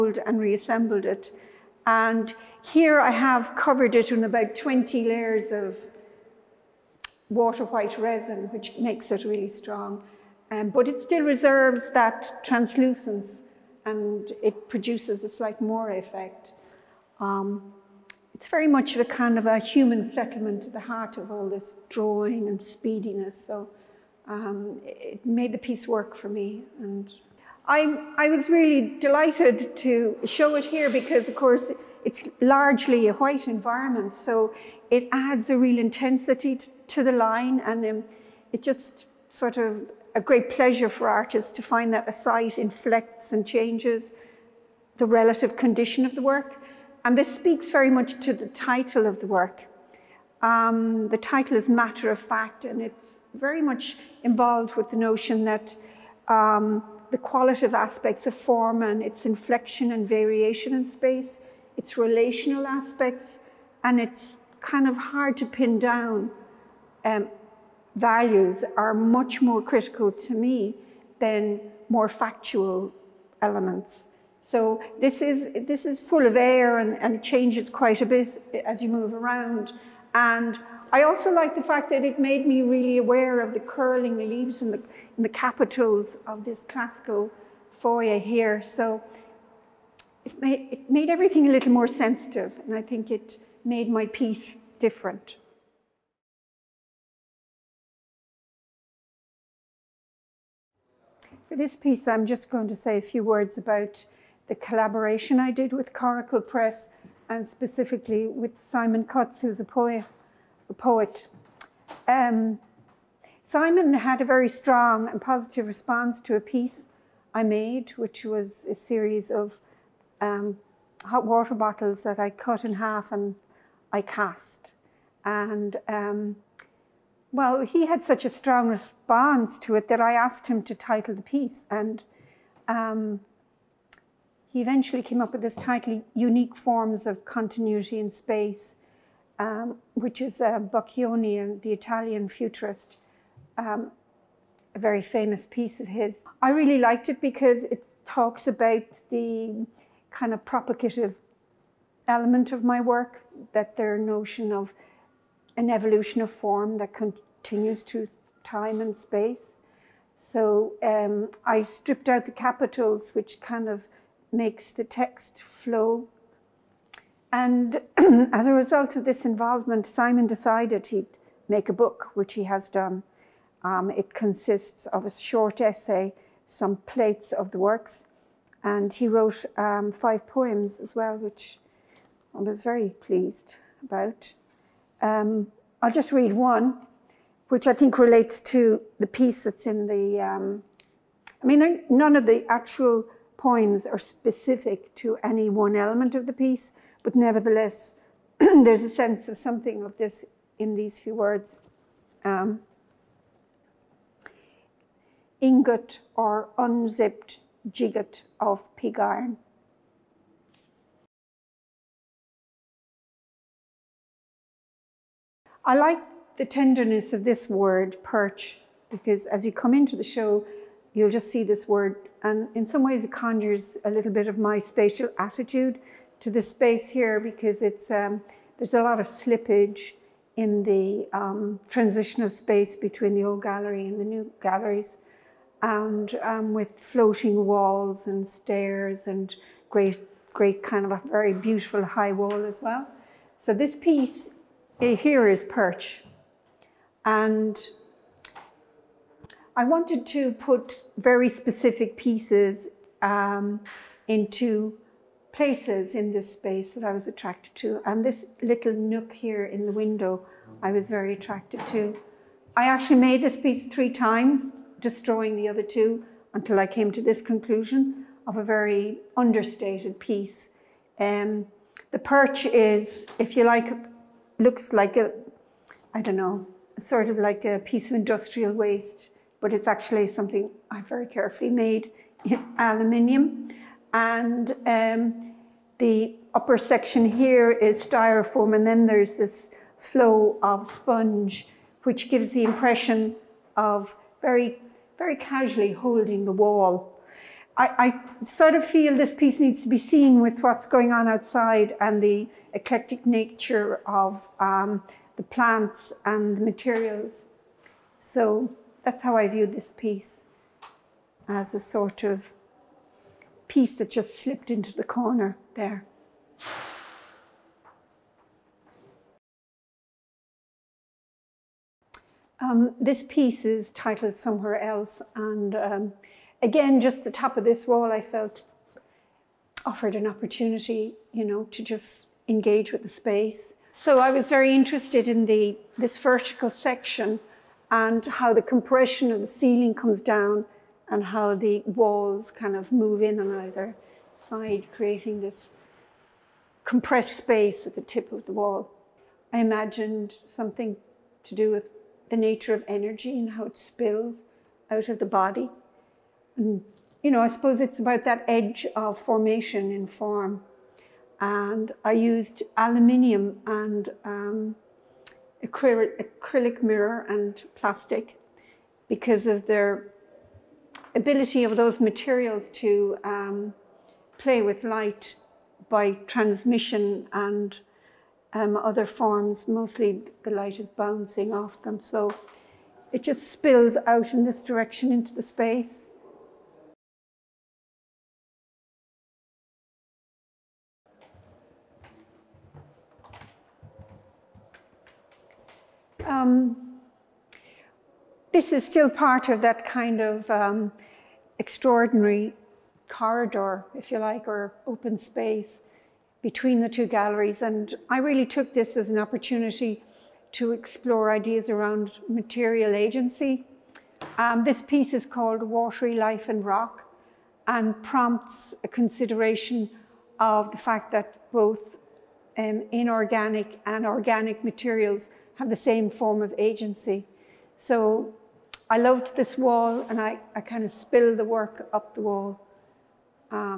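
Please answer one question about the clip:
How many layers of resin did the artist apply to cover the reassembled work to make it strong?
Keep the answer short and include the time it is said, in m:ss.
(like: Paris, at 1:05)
20, at 0:04.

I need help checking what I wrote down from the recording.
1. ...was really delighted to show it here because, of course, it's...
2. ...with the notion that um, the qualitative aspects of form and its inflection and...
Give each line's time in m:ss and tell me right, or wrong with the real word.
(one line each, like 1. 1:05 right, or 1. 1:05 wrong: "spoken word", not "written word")
1. 0:28 right
2. 0:54 right.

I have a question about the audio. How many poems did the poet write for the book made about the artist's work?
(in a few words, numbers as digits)
5.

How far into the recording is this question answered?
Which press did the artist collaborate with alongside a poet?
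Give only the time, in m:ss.
1:45.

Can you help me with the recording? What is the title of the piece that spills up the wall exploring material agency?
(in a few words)
Watery Life and Rock.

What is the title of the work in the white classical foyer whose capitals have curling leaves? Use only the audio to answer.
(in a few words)
Matter of Fact.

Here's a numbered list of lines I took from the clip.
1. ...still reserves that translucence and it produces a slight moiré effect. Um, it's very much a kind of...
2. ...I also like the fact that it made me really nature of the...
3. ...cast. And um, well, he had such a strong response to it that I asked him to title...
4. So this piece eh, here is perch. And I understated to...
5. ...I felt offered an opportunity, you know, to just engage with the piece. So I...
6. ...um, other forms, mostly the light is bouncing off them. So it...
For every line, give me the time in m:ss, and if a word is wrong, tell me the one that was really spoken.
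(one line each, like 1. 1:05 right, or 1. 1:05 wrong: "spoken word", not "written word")
1. 0:11 right
2. 1:20 wrong: "aware", not "nature"
3. 2:04 right
4. 4:03 wrong: "wanted", not "understated"
5. 5:27 wrong: "space", not "piece"
6. 6:18 right.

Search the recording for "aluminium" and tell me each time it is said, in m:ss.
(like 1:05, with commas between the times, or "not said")
4:42, 6:02.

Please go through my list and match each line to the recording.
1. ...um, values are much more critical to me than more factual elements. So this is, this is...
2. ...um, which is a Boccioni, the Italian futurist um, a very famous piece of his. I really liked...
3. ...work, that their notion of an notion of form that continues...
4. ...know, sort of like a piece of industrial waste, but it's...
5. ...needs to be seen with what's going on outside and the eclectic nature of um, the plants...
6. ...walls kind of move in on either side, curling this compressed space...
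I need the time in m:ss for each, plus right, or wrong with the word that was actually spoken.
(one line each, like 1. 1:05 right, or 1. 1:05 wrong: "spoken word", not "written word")
1. 1:07 right
2. 2:19 right
3. 2:32 wrong: "evolution", not "notion"
4. 4:36 right
5. 4:59 right
6. 5:41 wrong: "creating", not "curling".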